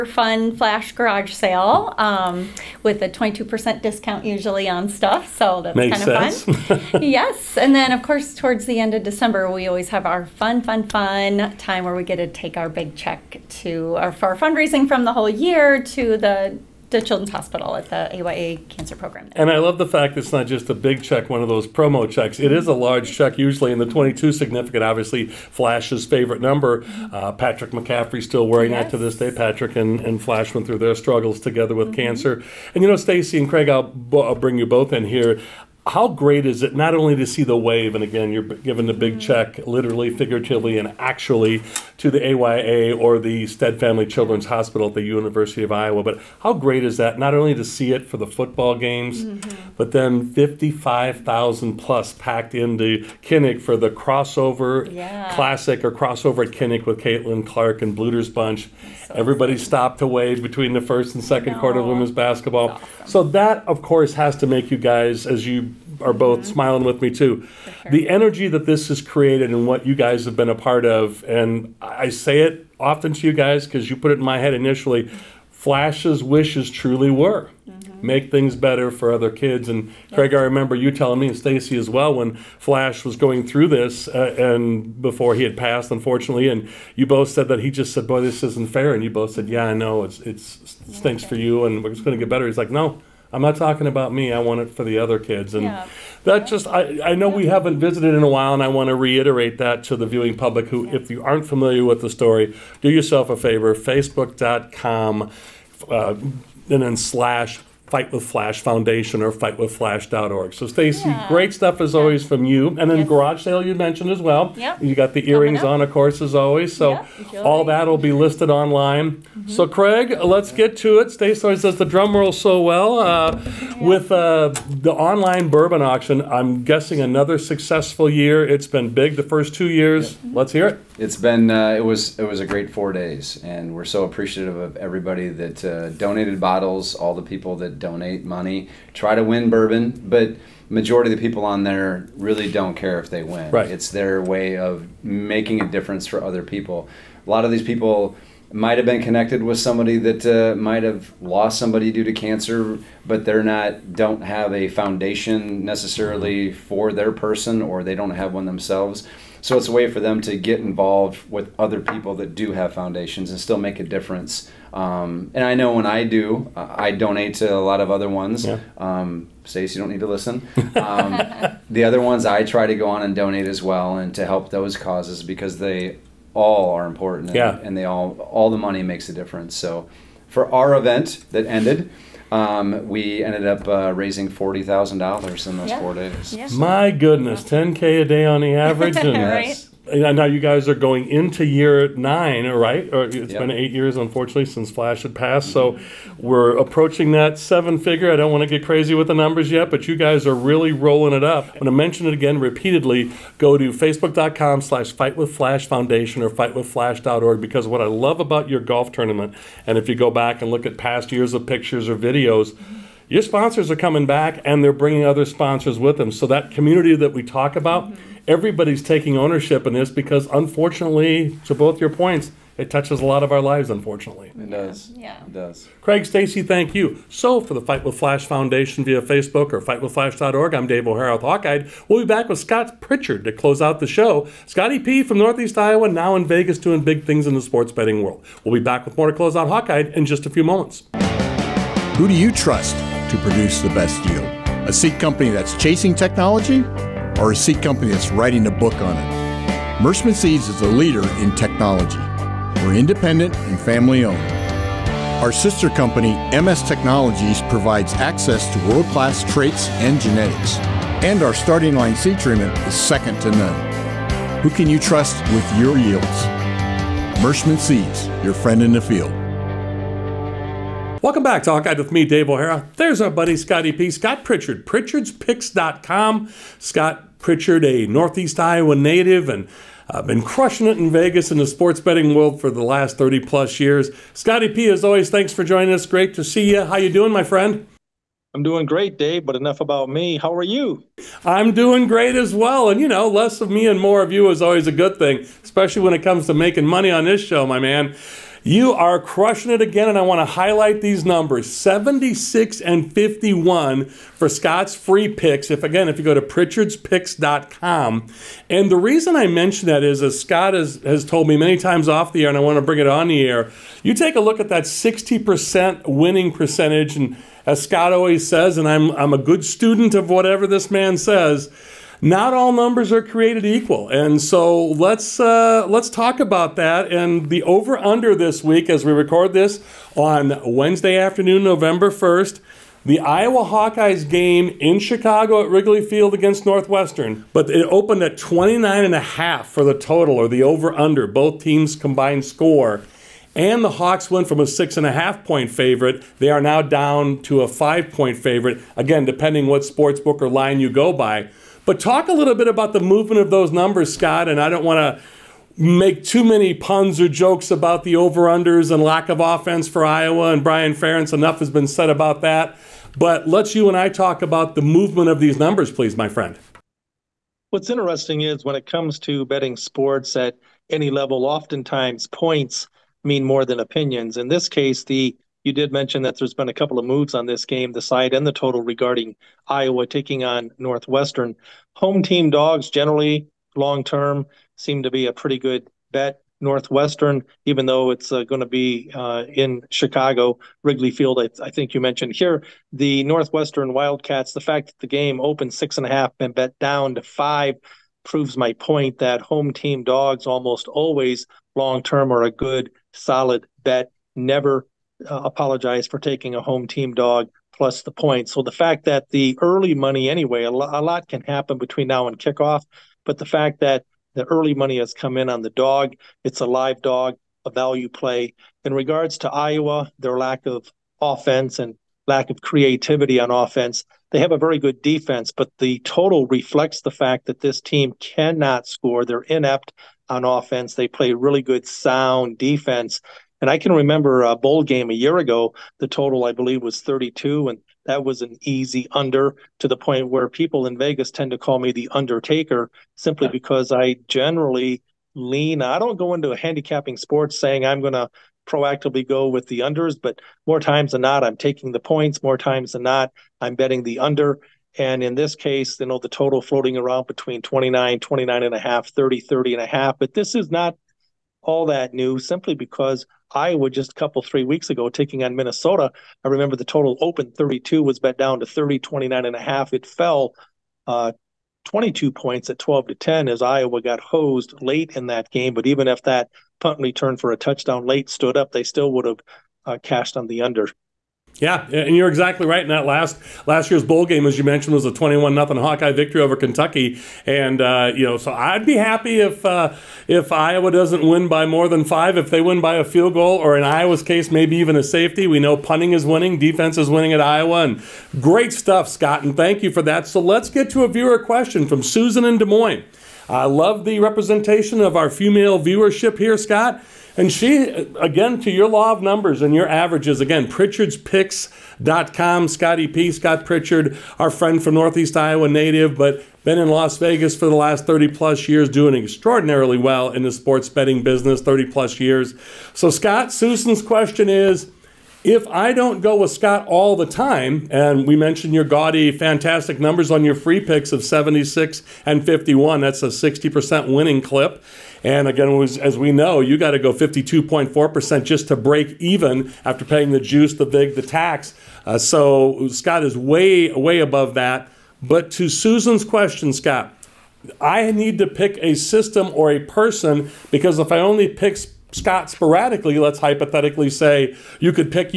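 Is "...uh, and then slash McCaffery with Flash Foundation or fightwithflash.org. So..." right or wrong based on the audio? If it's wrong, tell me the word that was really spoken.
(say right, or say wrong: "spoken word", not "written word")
wrong: "Fight", not "McCaffery".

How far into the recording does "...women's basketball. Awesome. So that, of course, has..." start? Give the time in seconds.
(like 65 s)
61 s.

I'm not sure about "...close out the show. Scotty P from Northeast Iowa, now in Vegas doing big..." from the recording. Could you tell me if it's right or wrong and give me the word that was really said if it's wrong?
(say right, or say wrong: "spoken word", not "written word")
right.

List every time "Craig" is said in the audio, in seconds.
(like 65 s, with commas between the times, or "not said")
33 s, 80 s, 119 s, 225 s.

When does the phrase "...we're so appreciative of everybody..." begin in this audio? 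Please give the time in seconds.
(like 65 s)
133 s.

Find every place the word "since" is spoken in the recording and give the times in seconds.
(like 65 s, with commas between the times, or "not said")
194 s.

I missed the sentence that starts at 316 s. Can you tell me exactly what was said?
And as Scott always says, and I'm, I'm a good student of whatever this man says, not all numbers are created equal.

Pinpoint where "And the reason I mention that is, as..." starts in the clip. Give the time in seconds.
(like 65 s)
308 s.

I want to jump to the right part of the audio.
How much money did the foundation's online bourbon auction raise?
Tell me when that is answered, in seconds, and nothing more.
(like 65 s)
184 s.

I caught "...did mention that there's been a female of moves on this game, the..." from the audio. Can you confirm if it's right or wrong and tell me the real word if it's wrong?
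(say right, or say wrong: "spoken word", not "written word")
wrong: "couple", not "female".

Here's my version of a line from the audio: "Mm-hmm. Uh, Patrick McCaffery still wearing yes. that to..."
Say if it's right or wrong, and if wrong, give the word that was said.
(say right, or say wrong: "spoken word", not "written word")
right.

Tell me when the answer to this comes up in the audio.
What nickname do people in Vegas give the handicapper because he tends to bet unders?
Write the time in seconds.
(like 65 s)
441 s.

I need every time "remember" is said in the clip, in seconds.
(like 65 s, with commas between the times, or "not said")
80 s, 433 s, 466 s.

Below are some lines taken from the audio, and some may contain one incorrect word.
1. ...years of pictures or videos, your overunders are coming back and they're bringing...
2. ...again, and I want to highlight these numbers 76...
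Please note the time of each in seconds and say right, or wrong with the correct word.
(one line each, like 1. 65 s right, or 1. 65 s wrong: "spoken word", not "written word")
1. 211 s wrong: "sponsors", not "overunders"
2. 299 s right.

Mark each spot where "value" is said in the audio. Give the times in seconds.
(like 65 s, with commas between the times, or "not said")
417 s.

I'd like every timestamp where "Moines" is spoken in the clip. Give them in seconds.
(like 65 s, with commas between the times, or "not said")
502 s.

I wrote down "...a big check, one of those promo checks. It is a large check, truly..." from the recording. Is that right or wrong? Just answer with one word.
wrong.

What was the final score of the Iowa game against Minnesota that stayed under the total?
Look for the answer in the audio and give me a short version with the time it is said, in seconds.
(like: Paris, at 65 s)
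12 to 10, at 472 s.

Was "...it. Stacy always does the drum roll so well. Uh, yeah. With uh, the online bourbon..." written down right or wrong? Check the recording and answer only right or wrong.
right.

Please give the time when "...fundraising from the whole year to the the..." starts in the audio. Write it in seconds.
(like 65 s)
14 s.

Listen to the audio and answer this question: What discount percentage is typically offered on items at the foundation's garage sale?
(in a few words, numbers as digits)
22%.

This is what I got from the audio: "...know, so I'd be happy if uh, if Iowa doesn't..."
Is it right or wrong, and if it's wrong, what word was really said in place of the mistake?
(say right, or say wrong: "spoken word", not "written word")
right.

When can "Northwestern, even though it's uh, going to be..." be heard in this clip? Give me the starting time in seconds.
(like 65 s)
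386 s.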